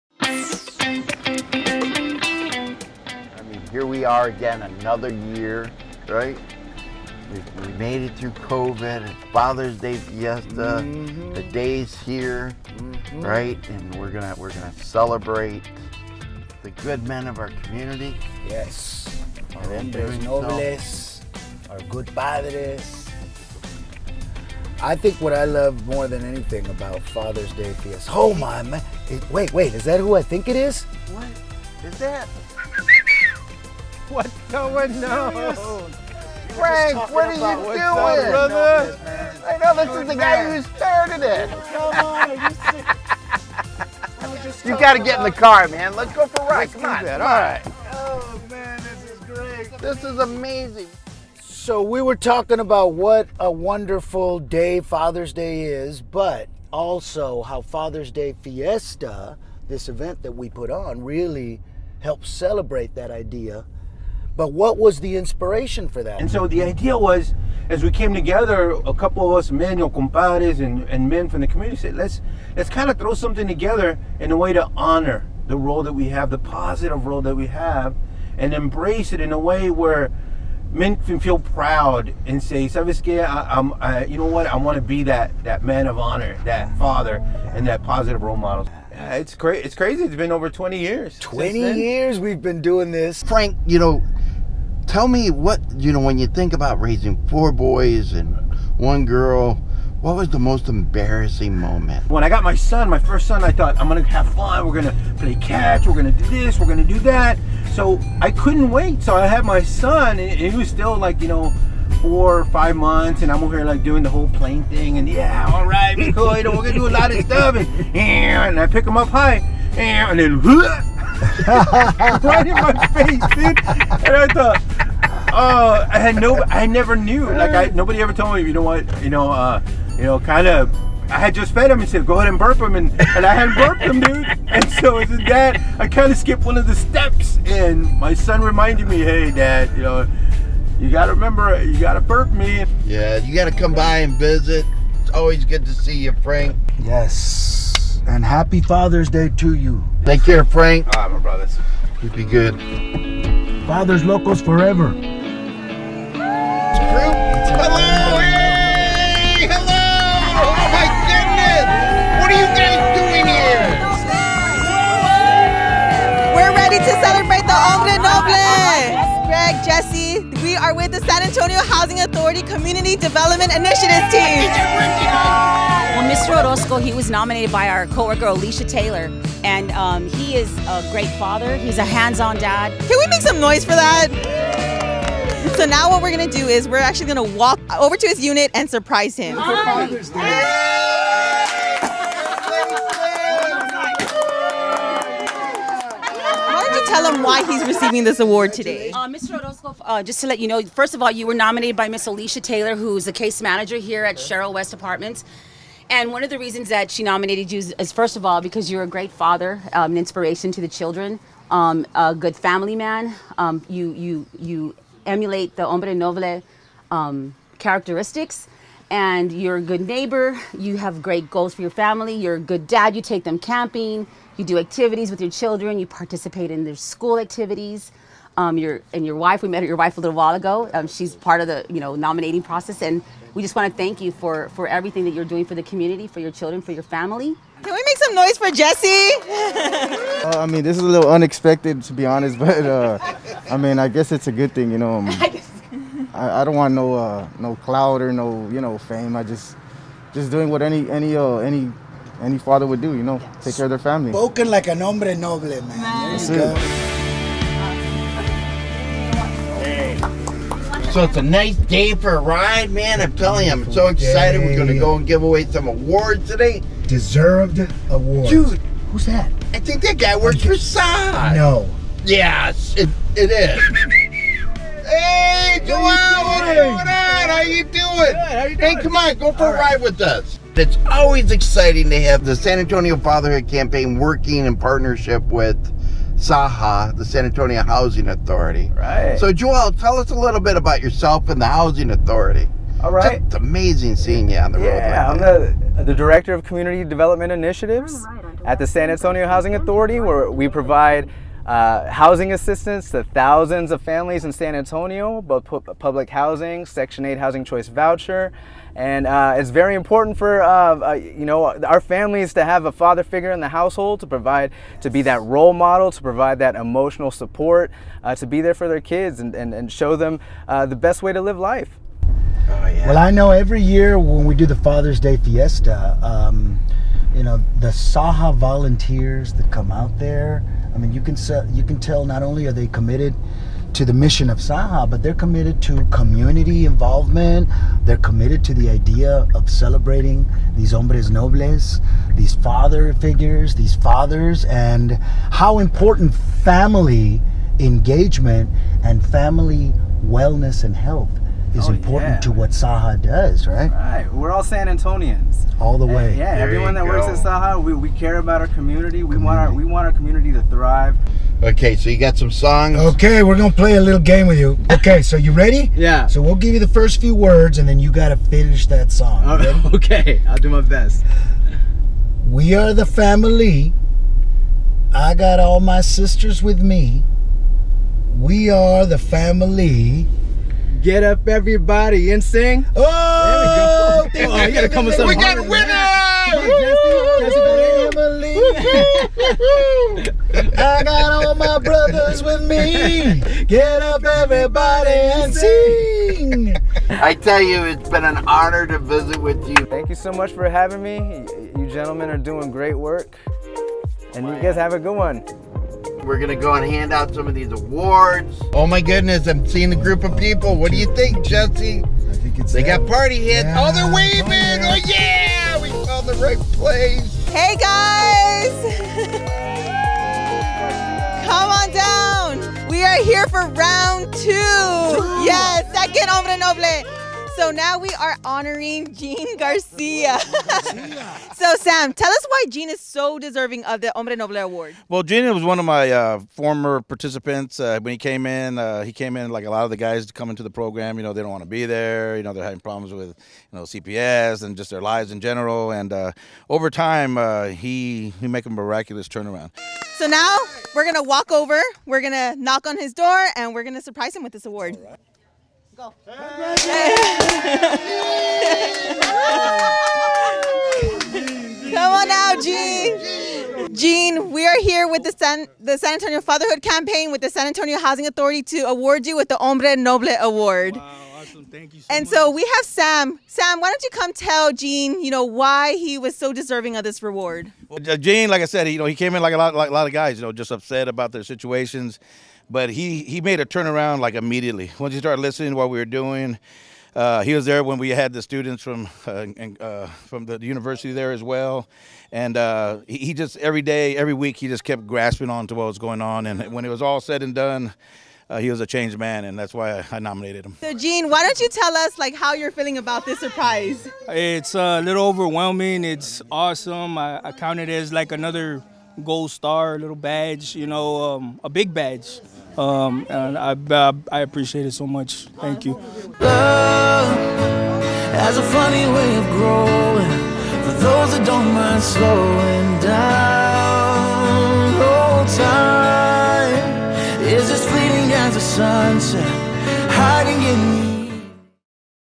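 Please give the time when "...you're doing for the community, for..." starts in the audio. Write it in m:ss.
3:55.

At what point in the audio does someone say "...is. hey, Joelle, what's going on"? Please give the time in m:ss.
4:33.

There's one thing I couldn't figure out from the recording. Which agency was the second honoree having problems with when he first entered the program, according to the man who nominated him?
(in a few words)
CPS.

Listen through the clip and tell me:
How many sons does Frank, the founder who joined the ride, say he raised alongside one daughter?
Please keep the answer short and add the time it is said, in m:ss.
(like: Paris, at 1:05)
4, at 1:37.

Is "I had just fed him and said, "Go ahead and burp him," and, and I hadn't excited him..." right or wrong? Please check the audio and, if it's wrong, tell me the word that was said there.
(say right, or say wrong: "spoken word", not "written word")
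wrong: "burped", not "excited".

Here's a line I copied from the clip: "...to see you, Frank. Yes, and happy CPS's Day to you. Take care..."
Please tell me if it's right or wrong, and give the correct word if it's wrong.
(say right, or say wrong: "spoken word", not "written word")
wrong: "Father", not "CPS".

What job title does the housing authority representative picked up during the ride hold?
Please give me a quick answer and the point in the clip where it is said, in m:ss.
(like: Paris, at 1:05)
Director of Community Development Initiatives, at 4:55.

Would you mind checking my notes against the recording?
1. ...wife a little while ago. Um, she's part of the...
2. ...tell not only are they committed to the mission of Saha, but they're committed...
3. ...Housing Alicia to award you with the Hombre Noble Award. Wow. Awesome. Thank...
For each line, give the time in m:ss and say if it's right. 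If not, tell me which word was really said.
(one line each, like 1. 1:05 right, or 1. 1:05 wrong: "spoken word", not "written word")
1. 3:49 right
2. 5:31 right
3. 7:47 wrong: "Authority", not "Alicia".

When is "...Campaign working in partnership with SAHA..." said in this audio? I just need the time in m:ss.
4:43.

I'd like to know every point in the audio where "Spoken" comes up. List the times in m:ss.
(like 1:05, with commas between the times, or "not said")
4:14.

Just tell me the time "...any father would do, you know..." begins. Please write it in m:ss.
4:12.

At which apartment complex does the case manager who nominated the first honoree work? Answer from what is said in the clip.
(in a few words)
Cheryl West Apartments.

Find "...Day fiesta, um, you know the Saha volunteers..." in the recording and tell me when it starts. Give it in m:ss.
5:24.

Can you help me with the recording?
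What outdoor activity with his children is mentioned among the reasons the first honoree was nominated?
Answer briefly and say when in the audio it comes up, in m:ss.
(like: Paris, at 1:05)
camping, at 3:43.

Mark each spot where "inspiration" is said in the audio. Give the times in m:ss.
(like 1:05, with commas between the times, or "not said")
1:05, 3:29.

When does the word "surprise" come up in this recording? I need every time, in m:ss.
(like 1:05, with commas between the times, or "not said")
3:08, 7:33, 8:23.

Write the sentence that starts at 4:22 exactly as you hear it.
I'm telling you, I'm so excited.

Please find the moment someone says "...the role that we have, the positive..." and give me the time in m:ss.
1:15.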